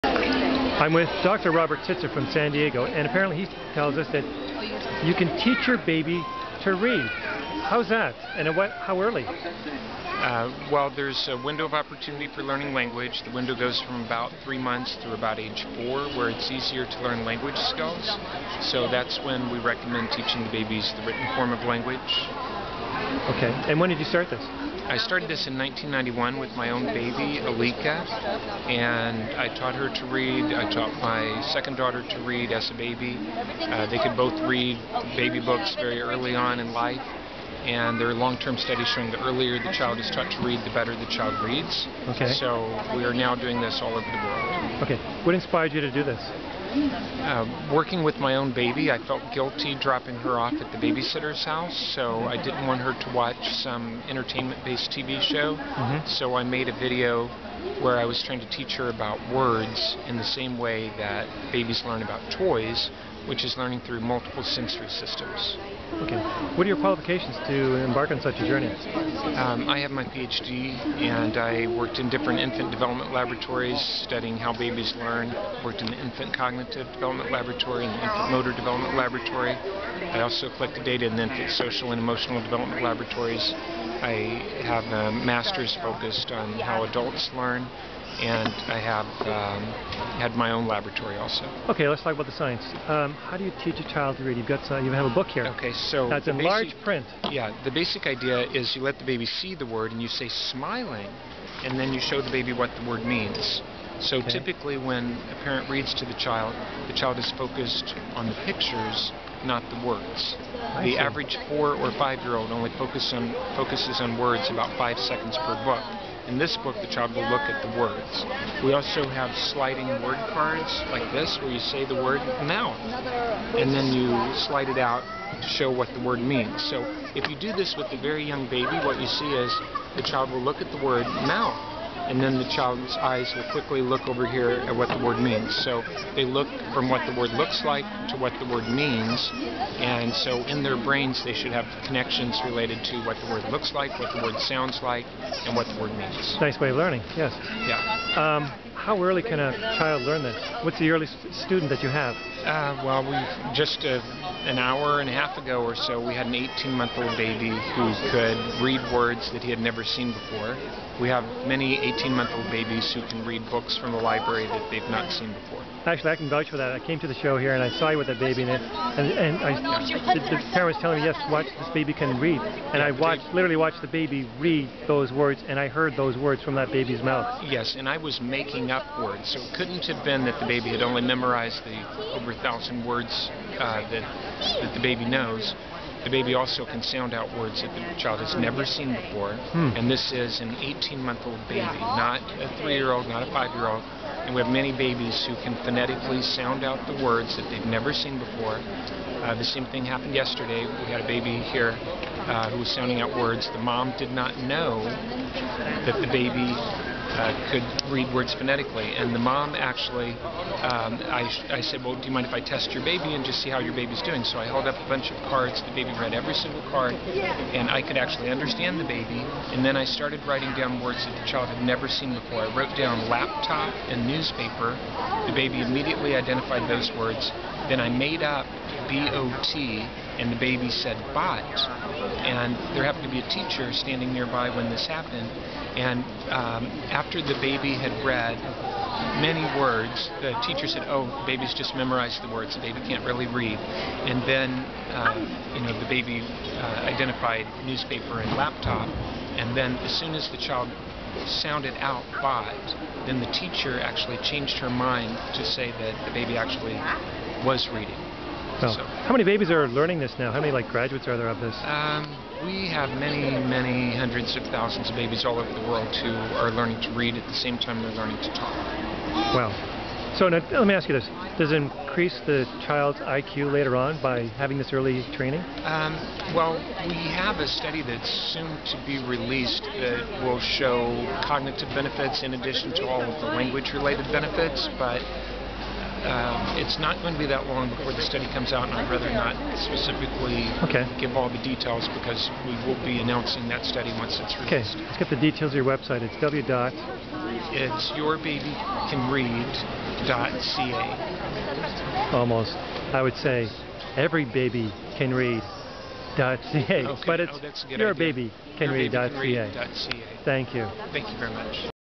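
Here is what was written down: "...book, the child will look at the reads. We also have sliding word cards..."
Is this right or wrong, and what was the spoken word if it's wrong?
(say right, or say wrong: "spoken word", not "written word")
wrong: "words", not "reads".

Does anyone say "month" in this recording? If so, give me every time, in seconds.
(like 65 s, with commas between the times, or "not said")
14 s, 156 s, 162 s, 190 s.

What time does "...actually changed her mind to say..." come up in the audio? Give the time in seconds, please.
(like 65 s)
253 s.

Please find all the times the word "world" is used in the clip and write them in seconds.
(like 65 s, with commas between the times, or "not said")
44 s, 265 s.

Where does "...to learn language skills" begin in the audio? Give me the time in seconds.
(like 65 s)
16 s.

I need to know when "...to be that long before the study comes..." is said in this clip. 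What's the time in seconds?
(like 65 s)
287 s.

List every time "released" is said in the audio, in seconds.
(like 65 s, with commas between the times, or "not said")
279 s, 294 s.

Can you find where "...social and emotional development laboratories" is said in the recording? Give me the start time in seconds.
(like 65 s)
81 s.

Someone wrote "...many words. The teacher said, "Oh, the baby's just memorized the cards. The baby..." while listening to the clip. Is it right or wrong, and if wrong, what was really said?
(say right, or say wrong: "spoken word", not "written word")
wrong: "words", not "cards".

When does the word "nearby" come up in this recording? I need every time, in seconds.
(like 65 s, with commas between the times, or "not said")
234 s.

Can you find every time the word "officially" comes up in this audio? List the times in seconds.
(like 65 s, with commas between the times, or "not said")
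not said.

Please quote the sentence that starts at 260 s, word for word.
How many like graduates are there of this?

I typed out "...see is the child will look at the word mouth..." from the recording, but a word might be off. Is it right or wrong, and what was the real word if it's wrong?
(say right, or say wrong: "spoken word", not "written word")
right.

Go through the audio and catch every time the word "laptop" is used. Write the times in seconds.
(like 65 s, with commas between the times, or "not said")
223 s, 248 s.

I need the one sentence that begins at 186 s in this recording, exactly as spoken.
The baby also can sound out words that the child has never seen before.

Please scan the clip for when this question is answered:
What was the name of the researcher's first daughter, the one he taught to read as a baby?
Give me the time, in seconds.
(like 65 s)
27 s.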